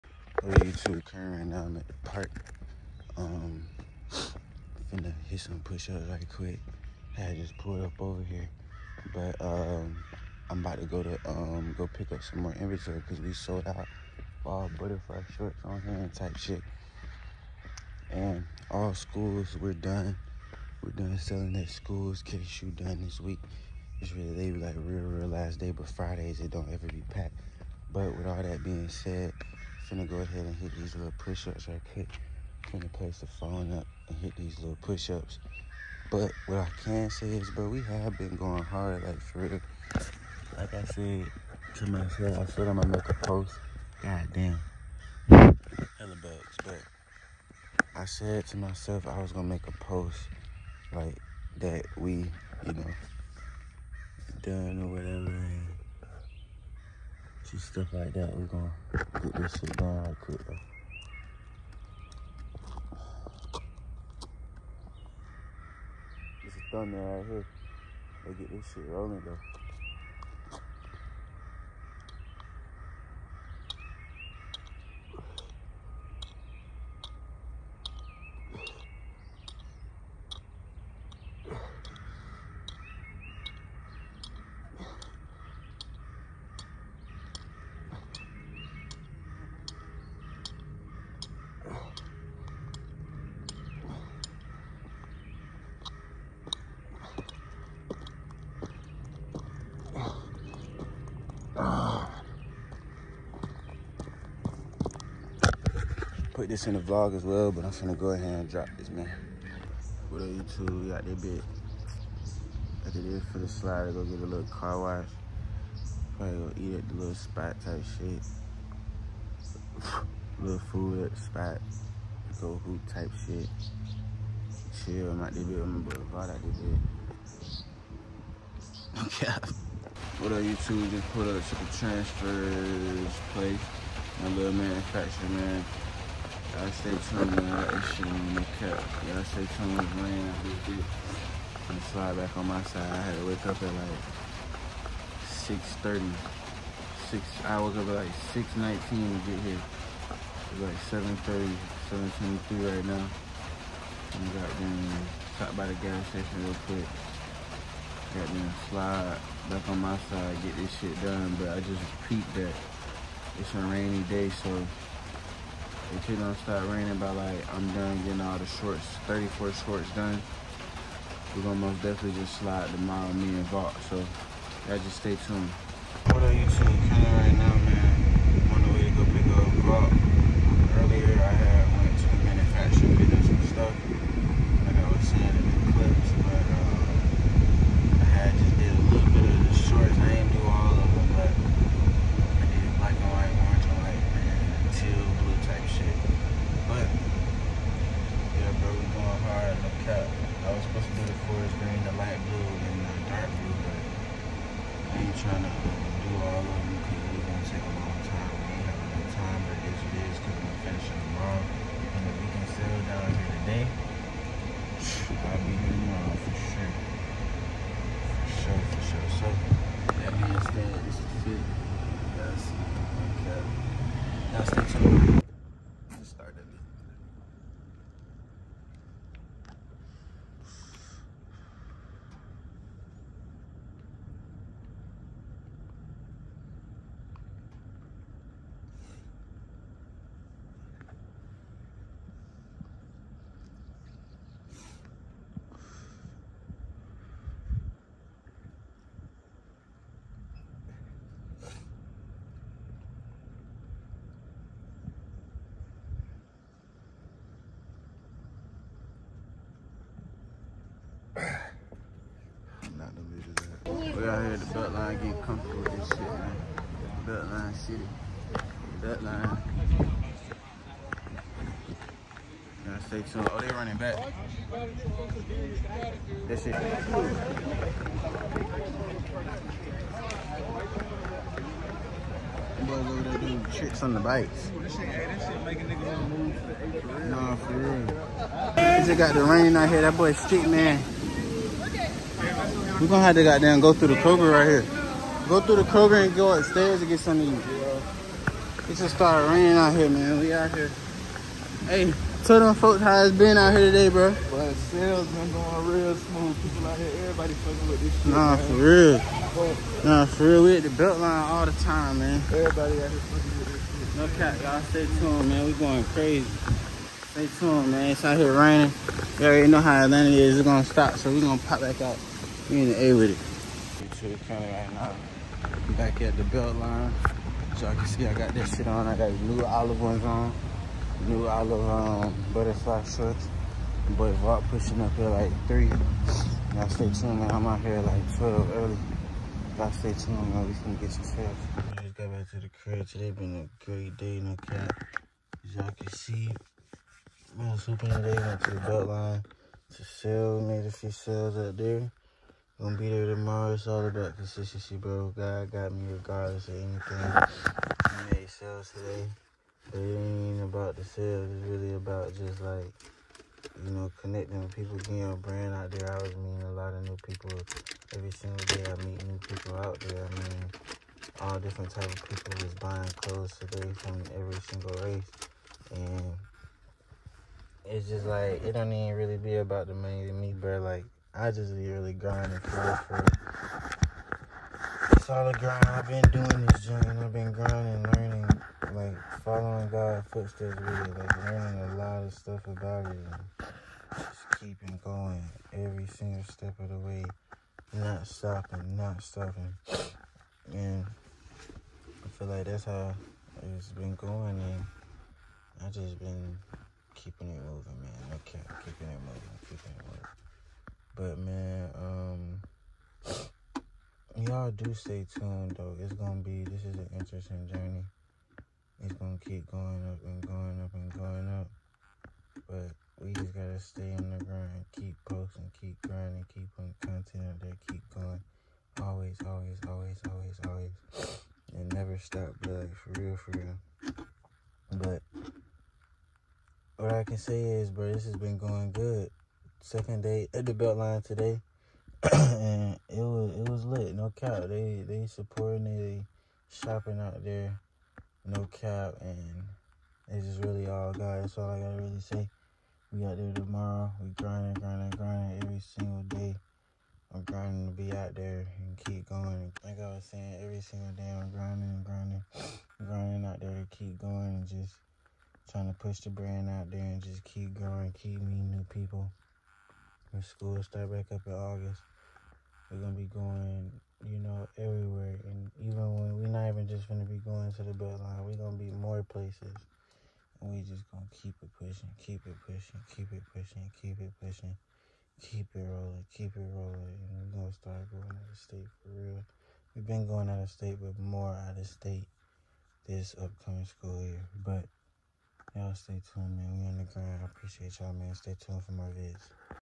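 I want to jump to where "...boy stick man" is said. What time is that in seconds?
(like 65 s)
289 s.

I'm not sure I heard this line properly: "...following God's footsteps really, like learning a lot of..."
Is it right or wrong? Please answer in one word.
right.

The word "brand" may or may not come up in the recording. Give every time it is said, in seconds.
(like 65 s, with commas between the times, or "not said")
365 s, 466 s.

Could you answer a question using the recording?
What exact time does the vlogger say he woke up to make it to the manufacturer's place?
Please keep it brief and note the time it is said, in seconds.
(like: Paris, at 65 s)
6:19, at 148 s.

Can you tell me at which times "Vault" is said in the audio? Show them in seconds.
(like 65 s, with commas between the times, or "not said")
173 s, 179 s, 334 s.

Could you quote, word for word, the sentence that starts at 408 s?
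Okay, keeping it moving, keeping it moving.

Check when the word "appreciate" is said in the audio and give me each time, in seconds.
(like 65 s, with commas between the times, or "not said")
497 s.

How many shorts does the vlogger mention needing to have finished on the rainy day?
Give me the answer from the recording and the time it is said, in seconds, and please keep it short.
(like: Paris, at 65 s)
34, at 169 s.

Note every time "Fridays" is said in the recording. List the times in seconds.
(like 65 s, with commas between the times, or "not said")
25 s.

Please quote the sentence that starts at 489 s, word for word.
We've been going out of state, but more out of state this upcoming school year.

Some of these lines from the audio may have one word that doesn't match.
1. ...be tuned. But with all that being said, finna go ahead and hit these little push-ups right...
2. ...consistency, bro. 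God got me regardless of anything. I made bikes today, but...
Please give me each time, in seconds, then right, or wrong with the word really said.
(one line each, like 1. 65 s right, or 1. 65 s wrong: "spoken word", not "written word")
1. 26 s wrong: "packed", not "tuned"
2. 354 s wrong: "sales", not "bikes".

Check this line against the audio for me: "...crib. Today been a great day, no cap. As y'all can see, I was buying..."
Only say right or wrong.
wrong.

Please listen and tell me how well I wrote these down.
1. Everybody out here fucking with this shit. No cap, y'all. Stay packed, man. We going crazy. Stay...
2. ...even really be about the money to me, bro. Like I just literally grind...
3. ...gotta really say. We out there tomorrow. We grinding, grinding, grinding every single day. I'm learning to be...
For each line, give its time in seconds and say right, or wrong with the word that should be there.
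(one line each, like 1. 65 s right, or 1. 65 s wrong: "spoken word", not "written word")
1. 312 s wrong: "tuned", not "packed"
2. 378 s right
3. 451 s wrong: "grinding", not "learning".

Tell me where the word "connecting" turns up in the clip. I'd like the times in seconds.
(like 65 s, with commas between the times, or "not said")
363 s.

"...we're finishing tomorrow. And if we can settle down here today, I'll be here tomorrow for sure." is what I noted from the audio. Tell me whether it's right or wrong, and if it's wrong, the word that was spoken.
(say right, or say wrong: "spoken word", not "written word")
right.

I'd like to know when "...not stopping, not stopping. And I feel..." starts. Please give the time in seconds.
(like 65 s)
397 s.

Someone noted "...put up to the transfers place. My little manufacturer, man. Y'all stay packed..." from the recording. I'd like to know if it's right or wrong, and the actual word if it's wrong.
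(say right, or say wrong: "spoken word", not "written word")
wrong: "tuned", not "packed".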